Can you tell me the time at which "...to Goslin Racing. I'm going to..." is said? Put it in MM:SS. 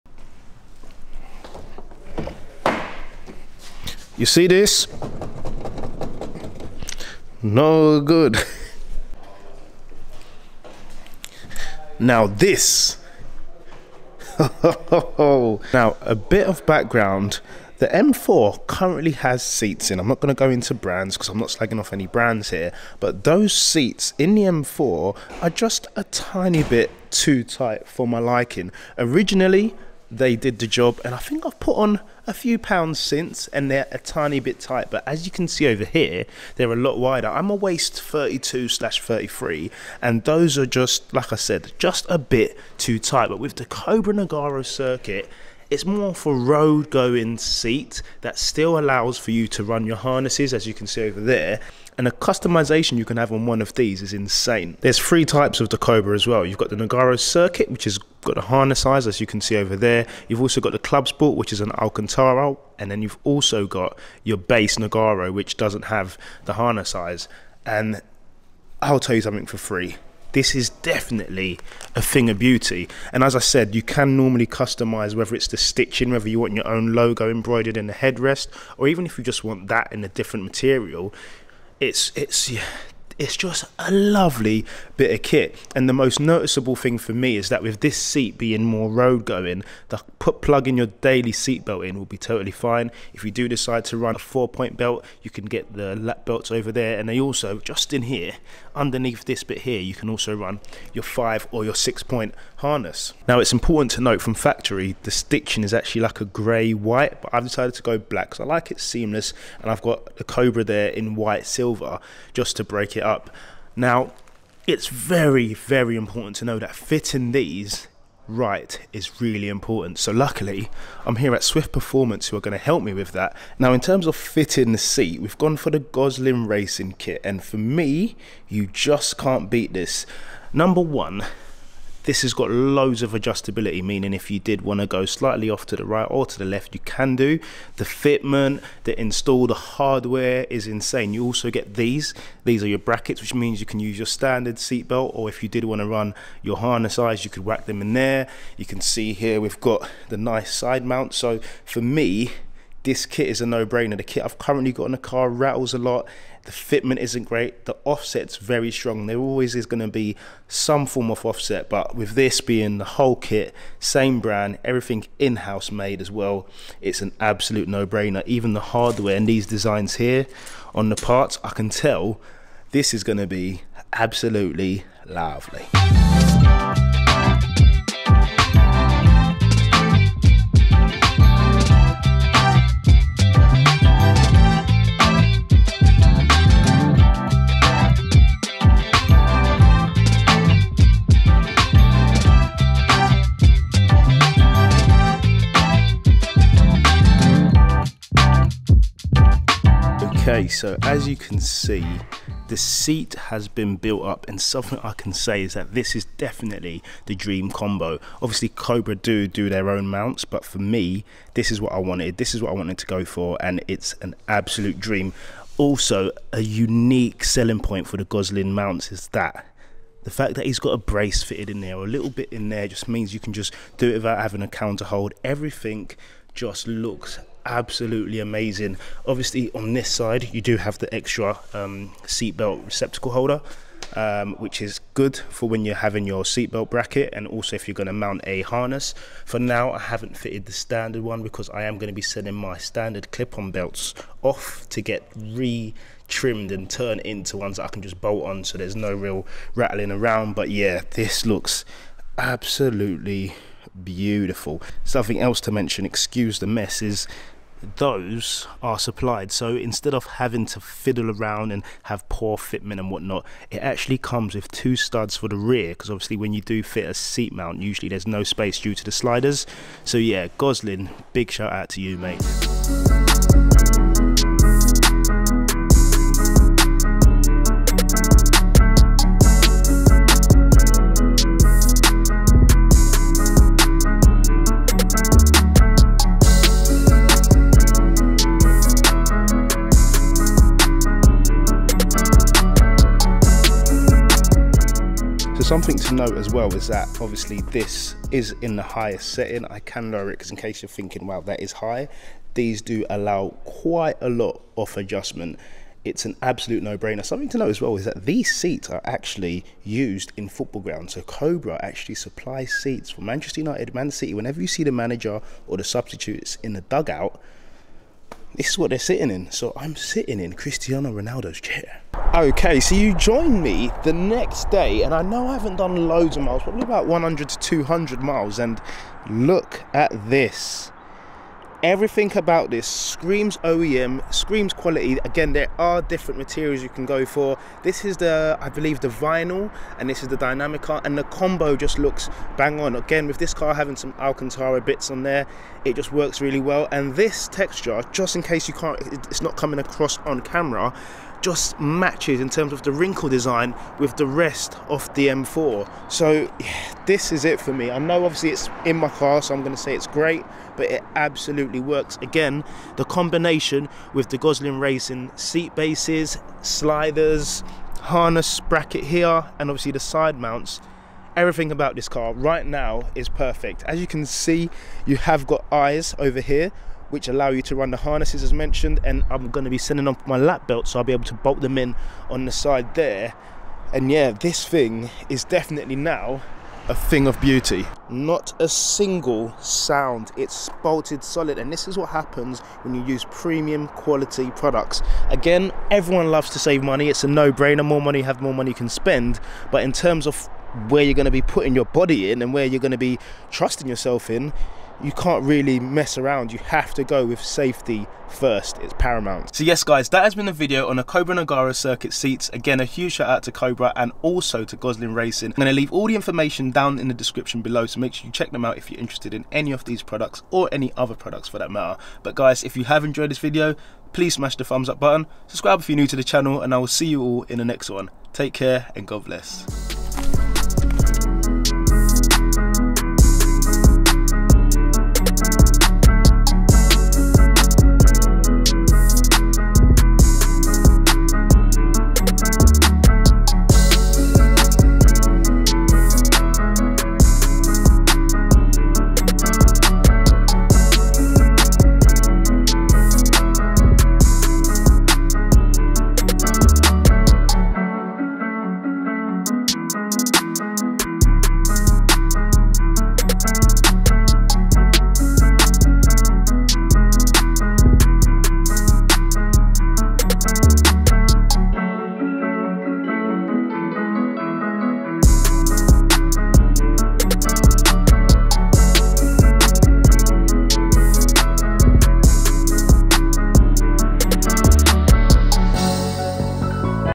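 06:54.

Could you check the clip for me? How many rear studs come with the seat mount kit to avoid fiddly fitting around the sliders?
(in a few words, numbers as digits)
2.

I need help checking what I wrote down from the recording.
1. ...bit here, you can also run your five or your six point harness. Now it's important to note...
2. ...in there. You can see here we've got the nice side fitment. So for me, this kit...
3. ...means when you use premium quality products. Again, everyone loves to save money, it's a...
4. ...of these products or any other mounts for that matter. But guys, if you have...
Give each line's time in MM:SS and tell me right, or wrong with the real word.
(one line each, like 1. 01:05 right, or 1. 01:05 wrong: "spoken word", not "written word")
1. 01:39 right
2. 02:27 wrong: "mount", not "fitment"
3. 06:31 wrong: "happens", not "means"
4. 06:59 wrong: "products", not "mounts".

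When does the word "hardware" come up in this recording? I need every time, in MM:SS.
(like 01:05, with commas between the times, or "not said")
02:19, 02:48.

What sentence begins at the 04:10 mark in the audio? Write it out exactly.
But yeah, this looks absolutely beautiful.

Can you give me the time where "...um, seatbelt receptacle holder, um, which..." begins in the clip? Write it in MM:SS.
03:51.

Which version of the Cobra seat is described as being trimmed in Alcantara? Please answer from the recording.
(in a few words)
Club Sport.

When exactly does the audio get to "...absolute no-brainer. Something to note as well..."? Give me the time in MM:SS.
05:06.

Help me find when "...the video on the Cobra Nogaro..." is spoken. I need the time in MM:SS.
06:50.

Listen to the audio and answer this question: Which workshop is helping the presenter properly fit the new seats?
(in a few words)
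Swift Performance.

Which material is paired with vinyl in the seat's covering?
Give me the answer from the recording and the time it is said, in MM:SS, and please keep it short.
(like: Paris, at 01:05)
Dinamica, at 05:40.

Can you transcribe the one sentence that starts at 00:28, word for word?
Originally, they did the job, and I think I've put on a few pounds since, and they're a tiny bit tight.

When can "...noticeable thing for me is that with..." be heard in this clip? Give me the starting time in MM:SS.
01:26.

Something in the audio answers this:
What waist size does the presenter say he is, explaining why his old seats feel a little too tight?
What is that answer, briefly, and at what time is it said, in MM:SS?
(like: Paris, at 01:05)
32/33, at 00:38.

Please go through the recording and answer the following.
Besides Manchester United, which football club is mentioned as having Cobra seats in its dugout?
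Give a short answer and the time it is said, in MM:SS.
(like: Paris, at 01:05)
Man City, at 05:13.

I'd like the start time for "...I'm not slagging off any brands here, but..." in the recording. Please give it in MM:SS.
00:21.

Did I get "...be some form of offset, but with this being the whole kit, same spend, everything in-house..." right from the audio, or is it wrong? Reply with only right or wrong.
wrong.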